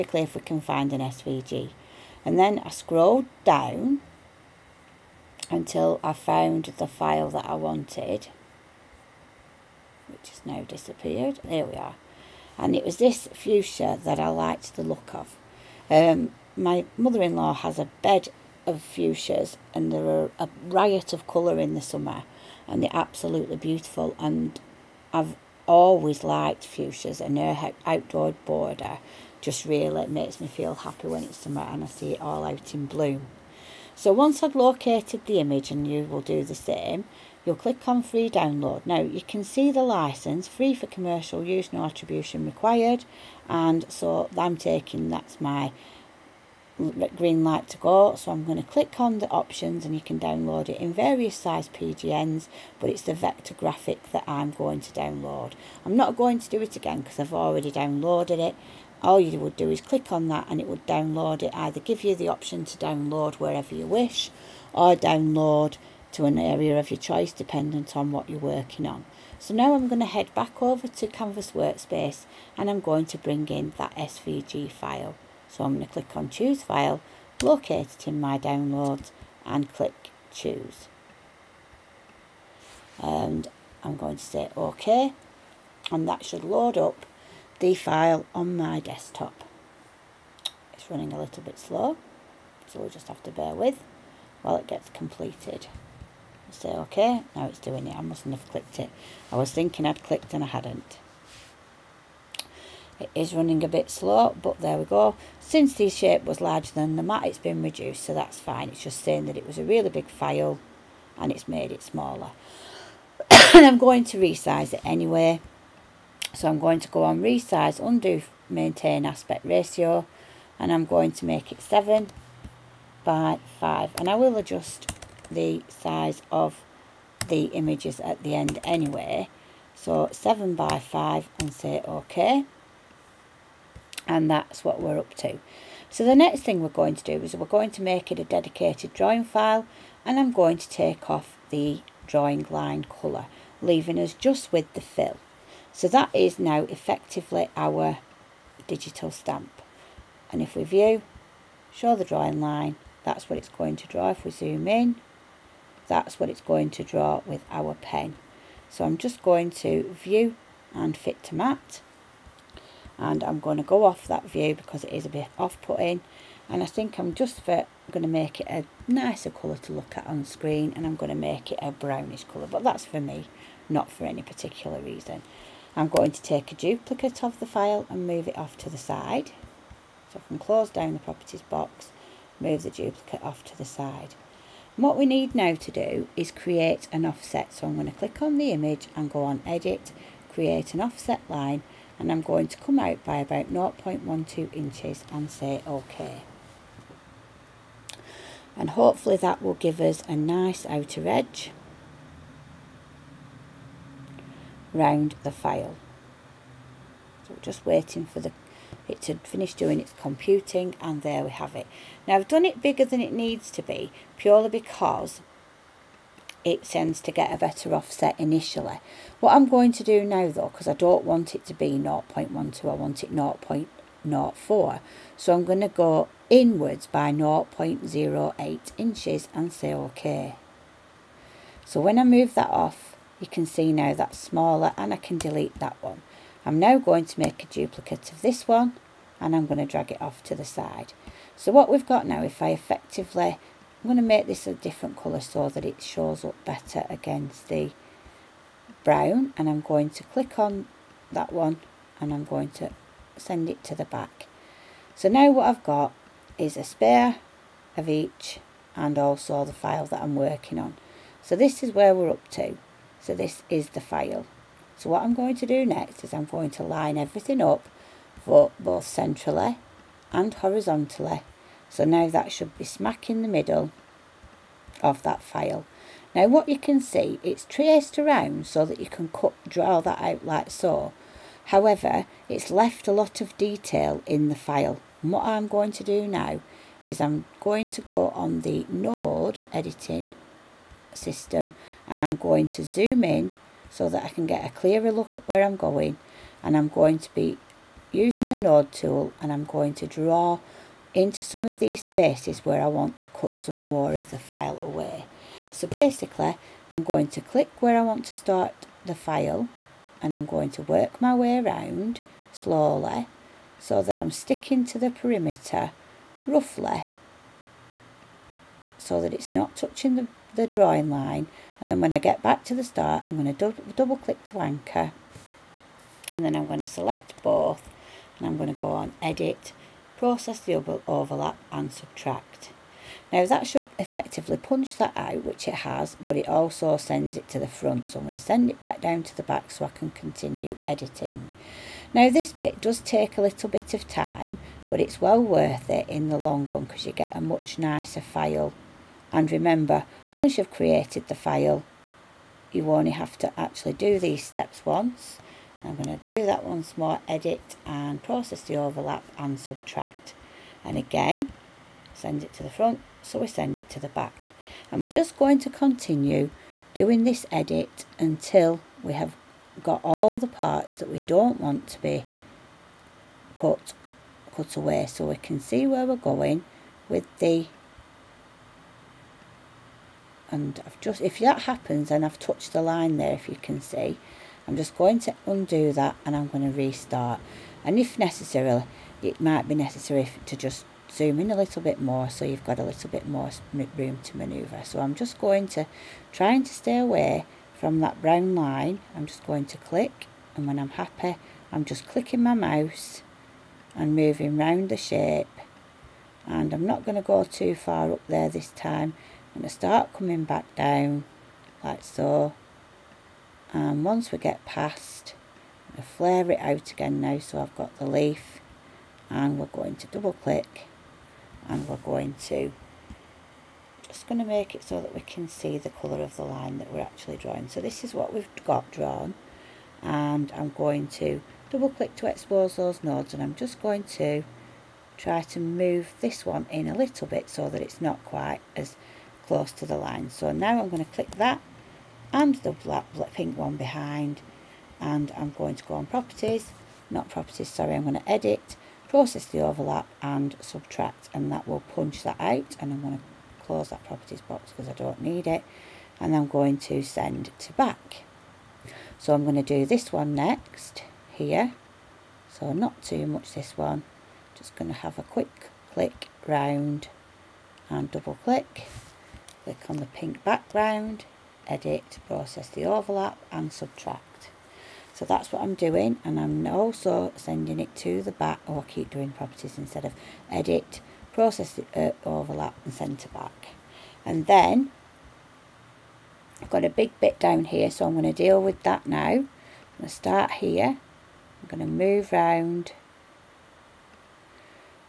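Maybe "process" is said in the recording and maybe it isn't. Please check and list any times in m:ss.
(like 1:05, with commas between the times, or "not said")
5:30, 5:58, 7:28, 7:52, 8:01.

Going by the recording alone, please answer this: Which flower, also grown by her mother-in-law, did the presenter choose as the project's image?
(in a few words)
Fuchsia.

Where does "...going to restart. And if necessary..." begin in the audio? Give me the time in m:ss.
6:26.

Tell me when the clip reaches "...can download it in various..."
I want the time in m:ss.
0:50.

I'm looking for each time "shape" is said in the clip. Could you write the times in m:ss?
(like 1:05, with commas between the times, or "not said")
1:45, 6:44.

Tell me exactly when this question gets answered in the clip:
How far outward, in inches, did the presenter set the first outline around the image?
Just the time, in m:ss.
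3:13.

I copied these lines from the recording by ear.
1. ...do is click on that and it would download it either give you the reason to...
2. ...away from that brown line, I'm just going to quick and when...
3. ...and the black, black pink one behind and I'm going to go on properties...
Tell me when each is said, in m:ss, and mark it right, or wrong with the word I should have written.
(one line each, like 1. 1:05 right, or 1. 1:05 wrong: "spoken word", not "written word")
1. 0:59 wrong: "option", not "reason"
2. 6:36 wrong: "click", not "quick"
3. 7:22 right.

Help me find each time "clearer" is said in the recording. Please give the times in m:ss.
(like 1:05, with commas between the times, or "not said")
4:54.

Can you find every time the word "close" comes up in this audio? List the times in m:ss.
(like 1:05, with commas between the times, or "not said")
3:00, 7:19, 7:33.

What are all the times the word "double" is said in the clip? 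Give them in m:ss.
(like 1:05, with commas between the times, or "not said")
5:23, 6:59, 7:11, 7:47.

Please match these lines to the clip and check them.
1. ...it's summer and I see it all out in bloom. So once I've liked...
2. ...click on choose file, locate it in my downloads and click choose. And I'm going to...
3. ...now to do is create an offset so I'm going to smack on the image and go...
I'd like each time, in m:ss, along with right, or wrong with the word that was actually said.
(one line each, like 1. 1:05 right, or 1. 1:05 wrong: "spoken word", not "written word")
1. 0:31 wrong: "located", not "liked"
2. 1:15 right
3. 3:05 wrong: "click", not "smack".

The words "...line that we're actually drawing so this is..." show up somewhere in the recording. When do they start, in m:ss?
7:06.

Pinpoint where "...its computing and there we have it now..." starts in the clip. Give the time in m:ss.
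3:29.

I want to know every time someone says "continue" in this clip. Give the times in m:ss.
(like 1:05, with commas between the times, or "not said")
5:39, 6:05.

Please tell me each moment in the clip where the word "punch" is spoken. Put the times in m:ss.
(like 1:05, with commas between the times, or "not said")
5:34, 7:31.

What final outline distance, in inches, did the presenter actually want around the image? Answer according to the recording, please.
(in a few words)
0.04.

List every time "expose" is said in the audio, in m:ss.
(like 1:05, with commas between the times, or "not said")
7:12.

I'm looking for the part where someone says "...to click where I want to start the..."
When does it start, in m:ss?
5:07.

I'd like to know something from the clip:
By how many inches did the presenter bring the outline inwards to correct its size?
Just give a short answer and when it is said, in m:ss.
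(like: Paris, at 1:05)
0.08 inches, at 3:47.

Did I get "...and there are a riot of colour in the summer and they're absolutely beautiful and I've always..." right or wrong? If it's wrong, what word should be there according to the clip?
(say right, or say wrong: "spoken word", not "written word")
right.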